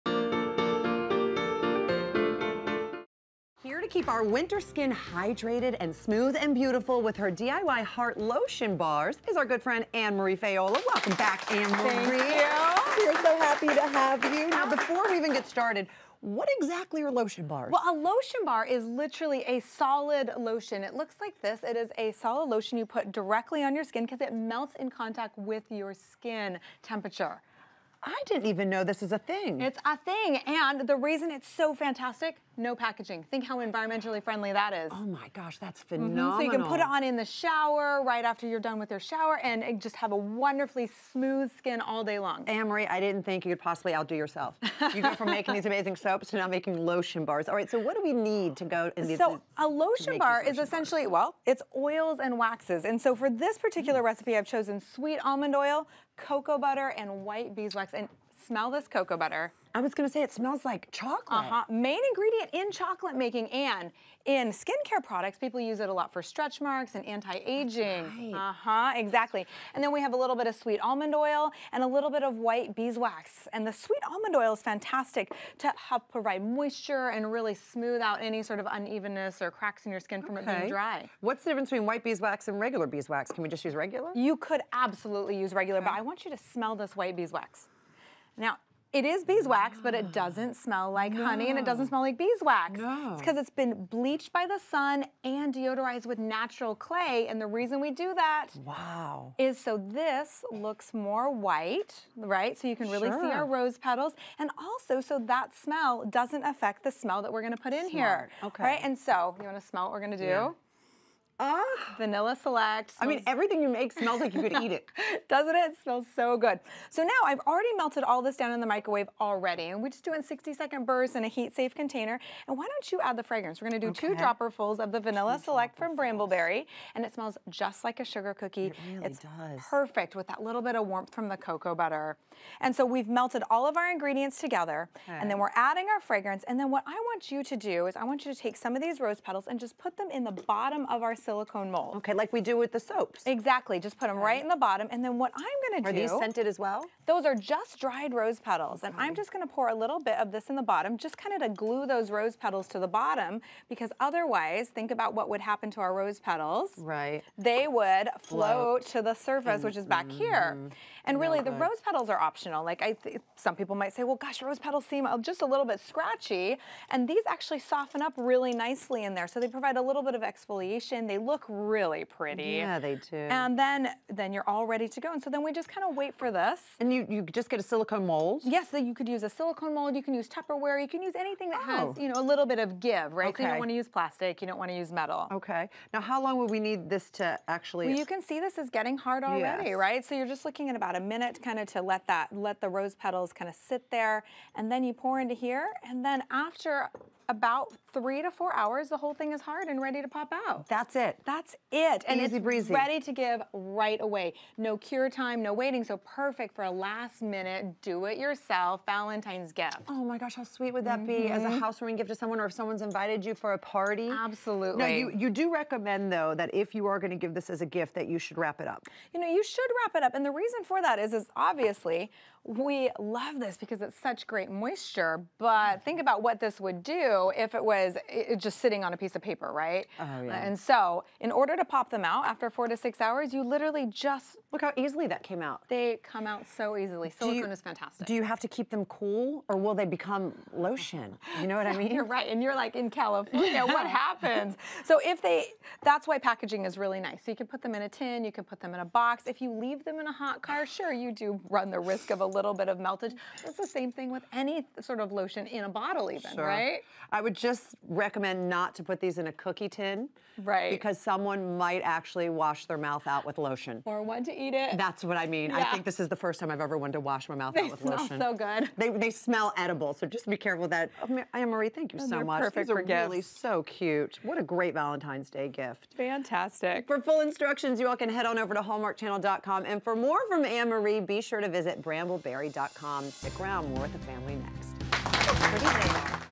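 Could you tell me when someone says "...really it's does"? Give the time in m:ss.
2:08.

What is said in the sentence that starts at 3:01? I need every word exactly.
has, you know, a little bit of give, right?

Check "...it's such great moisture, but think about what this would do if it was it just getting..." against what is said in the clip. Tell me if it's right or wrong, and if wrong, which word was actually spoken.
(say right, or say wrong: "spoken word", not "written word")
wrong: "sitting", not "getting".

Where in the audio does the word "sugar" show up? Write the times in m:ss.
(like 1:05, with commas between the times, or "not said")
2:08.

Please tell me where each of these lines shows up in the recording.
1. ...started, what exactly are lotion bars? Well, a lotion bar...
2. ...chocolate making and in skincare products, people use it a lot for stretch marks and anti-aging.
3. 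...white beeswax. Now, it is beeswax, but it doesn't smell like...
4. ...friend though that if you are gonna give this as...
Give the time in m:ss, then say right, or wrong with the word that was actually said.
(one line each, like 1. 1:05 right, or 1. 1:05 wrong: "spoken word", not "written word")
1. 0:15 right
2. 1:02 right
3. 1:26 right
4. 3:35 wrong: "recommend", not "friend".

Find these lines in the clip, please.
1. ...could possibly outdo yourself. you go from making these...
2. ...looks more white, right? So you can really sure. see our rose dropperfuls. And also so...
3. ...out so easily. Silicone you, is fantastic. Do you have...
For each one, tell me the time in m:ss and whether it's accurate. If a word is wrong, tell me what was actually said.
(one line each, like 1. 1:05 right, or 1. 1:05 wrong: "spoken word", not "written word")
1. 0:43 right
2. 1:40 wrong: "petals", not "dropperfuls"
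3. 3:56 right.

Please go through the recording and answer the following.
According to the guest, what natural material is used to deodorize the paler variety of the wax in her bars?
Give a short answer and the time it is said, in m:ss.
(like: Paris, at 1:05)
Natural clay, at 1:36.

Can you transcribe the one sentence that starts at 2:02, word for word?
And why don't you add the fragrance?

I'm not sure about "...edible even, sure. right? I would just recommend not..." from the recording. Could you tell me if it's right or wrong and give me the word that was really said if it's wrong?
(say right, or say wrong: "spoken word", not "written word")
wrong: "bottle", not "edible".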